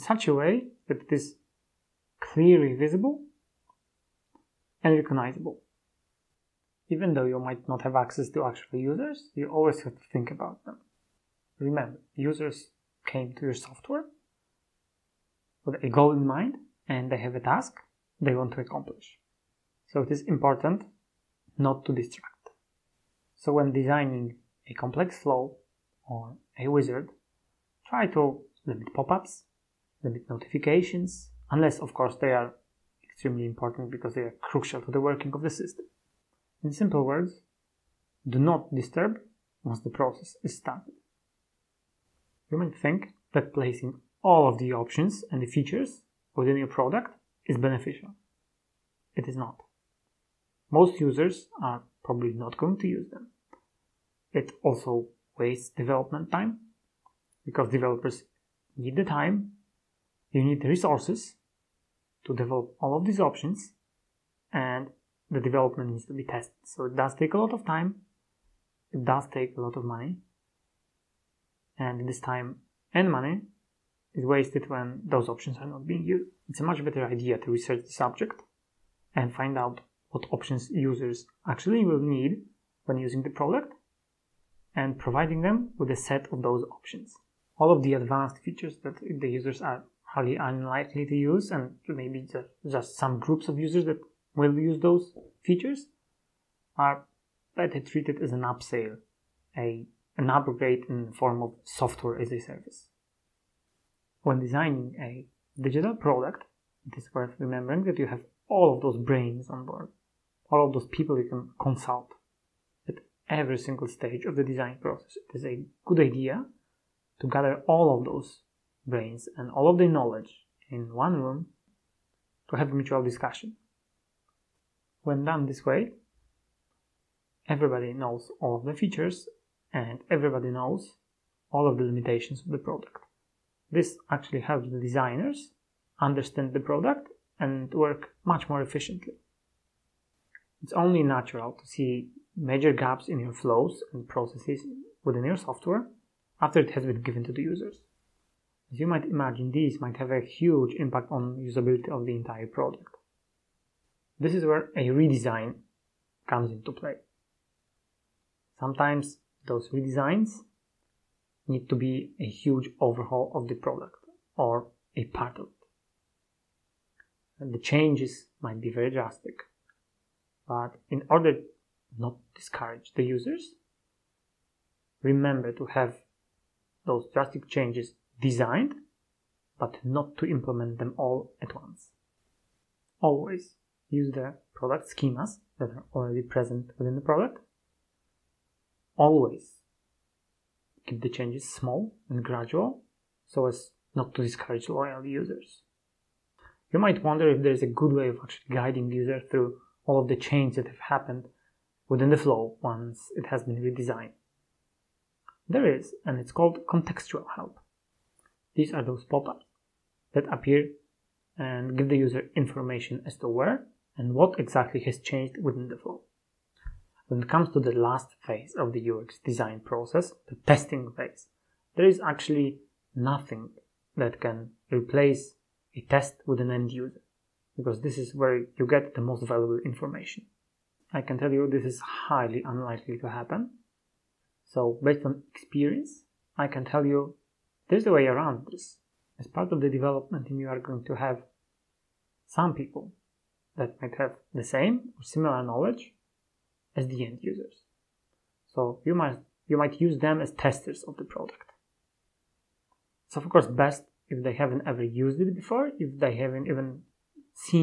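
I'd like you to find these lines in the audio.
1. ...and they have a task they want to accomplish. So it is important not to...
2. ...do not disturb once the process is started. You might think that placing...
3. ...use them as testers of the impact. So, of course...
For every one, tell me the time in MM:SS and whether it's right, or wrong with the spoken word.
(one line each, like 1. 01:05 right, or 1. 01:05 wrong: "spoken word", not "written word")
1. 00:16 right
2. 00:38 right
3. 04:09 wrong: "product", not "impact".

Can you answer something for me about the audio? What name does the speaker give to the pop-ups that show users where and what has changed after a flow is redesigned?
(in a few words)
contextual help.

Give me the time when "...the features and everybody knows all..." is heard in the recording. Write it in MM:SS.
02:08.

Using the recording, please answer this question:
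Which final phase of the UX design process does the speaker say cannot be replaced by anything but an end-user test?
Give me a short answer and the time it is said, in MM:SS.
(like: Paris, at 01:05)
the testing phase, at 03:40.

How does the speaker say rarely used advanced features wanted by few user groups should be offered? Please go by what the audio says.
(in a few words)
as an upsell.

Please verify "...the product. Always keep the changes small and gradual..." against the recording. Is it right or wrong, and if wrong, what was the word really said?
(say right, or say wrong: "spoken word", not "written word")
right.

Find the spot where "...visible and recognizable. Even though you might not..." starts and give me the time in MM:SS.
00:02.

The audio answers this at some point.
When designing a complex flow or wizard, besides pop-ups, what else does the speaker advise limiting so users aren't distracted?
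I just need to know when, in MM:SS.
00:30.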